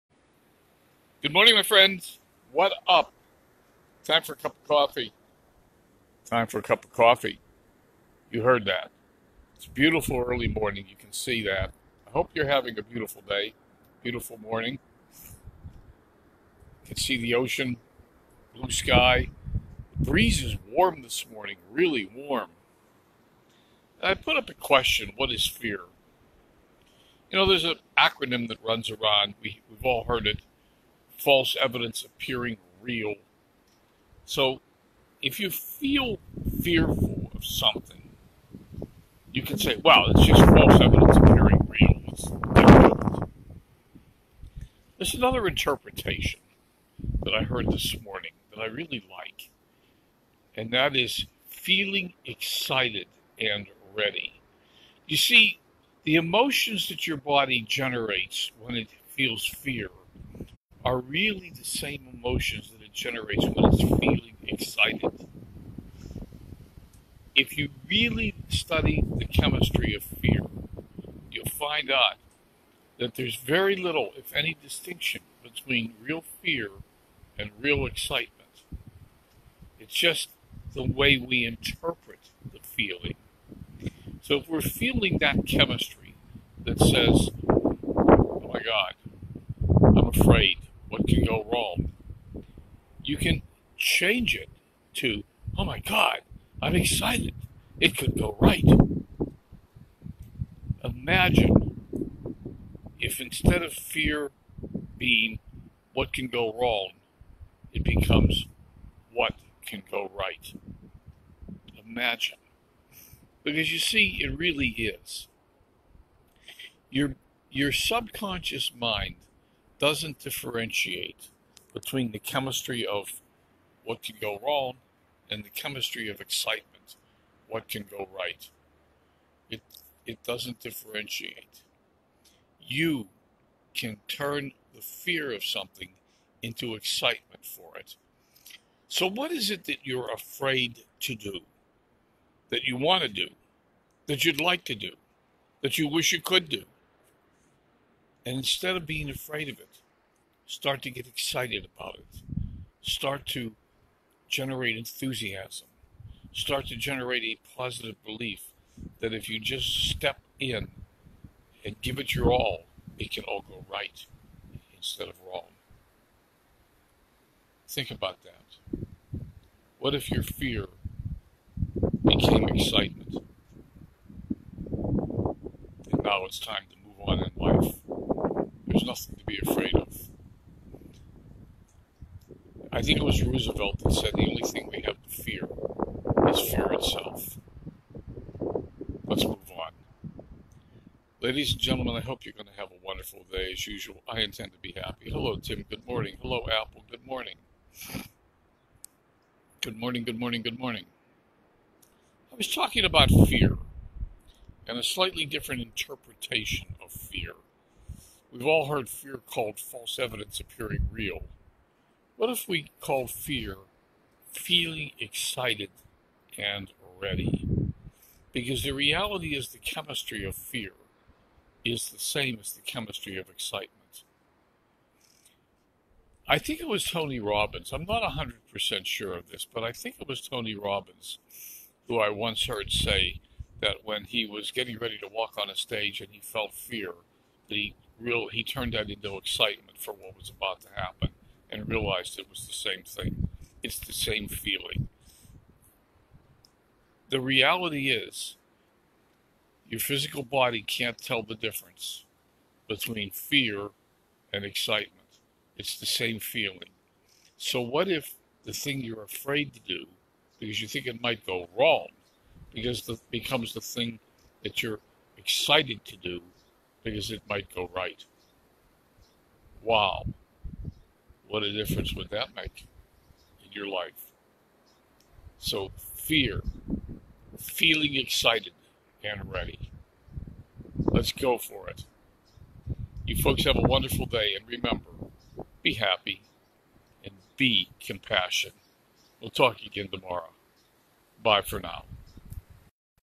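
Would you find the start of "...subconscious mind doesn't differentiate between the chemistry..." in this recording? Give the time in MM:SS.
01:57.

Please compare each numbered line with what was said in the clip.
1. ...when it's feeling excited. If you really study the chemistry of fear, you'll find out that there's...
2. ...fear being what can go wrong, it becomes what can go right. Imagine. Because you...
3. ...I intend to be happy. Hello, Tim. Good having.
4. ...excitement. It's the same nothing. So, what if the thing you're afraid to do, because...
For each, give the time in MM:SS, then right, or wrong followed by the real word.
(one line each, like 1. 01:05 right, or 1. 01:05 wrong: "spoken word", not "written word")
1. 01:03 right
2. 01:43 right
3. 03:14 wrong: "morning", not "having"
4. 04:14 wrong: "feeling", not "nothing".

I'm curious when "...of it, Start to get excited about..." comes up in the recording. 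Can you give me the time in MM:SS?
02:29.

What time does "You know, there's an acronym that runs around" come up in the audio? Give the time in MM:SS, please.
00:27.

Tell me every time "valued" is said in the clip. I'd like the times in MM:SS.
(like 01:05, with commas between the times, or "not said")
not said.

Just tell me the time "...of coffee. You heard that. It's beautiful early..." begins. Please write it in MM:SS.
00:06.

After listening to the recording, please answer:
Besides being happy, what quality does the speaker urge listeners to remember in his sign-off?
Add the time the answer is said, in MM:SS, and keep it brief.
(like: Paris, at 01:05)
compassionate, at 04:47.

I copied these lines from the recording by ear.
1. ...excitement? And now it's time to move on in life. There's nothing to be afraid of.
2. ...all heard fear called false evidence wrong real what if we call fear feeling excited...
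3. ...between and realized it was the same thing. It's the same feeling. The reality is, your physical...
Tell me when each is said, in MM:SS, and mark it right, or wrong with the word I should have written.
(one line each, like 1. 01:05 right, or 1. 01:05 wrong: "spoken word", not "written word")
1. 02:52 right
2. 03:28 wrong: "appearing", not "wrong"
3. 04:00 wrong: "happen", not "between".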